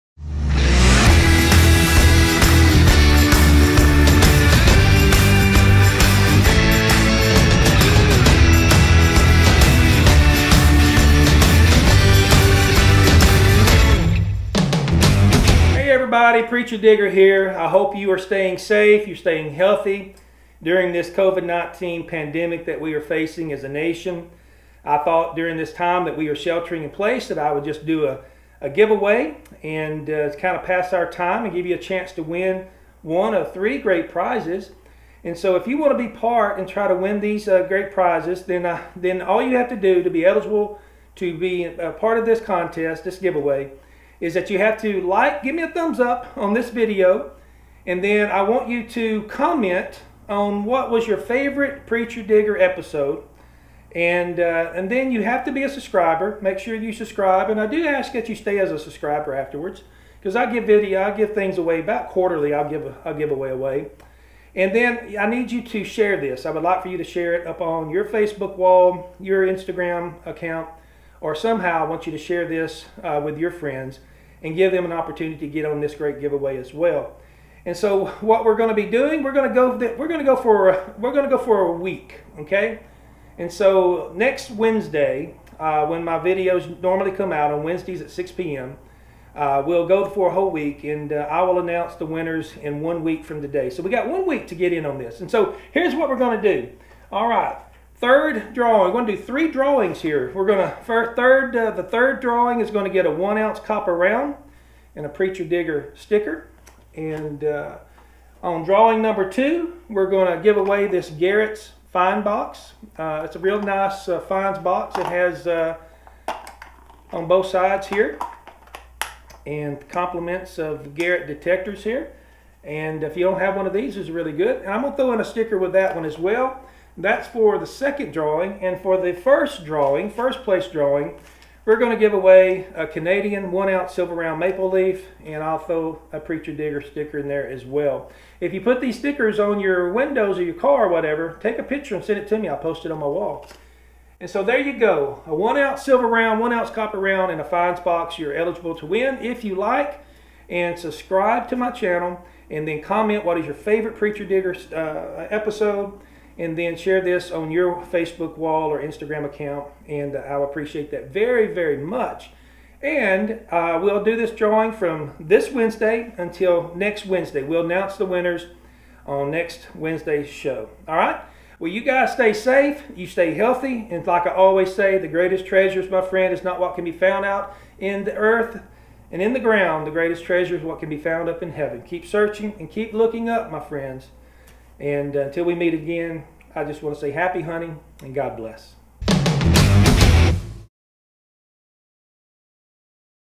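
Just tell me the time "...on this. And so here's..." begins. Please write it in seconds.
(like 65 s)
94 s.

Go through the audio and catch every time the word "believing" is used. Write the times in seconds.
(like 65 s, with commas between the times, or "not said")
not said.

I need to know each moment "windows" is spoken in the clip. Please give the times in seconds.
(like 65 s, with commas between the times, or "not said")
139 s.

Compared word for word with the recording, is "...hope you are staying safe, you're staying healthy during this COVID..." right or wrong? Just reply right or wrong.
right.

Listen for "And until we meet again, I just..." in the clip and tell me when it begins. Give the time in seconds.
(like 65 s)
184 s.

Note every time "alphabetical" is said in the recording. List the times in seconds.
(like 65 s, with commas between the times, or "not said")
not said.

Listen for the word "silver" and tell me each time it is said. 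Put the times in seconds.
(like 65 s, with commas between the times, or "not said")
133 s, 145 s.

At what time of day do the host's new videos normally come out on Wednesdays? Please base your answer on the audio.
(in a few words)
6 p.m.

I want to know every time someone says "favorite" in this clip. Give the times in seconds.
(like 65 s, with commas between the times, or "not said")
51 s, 153 s.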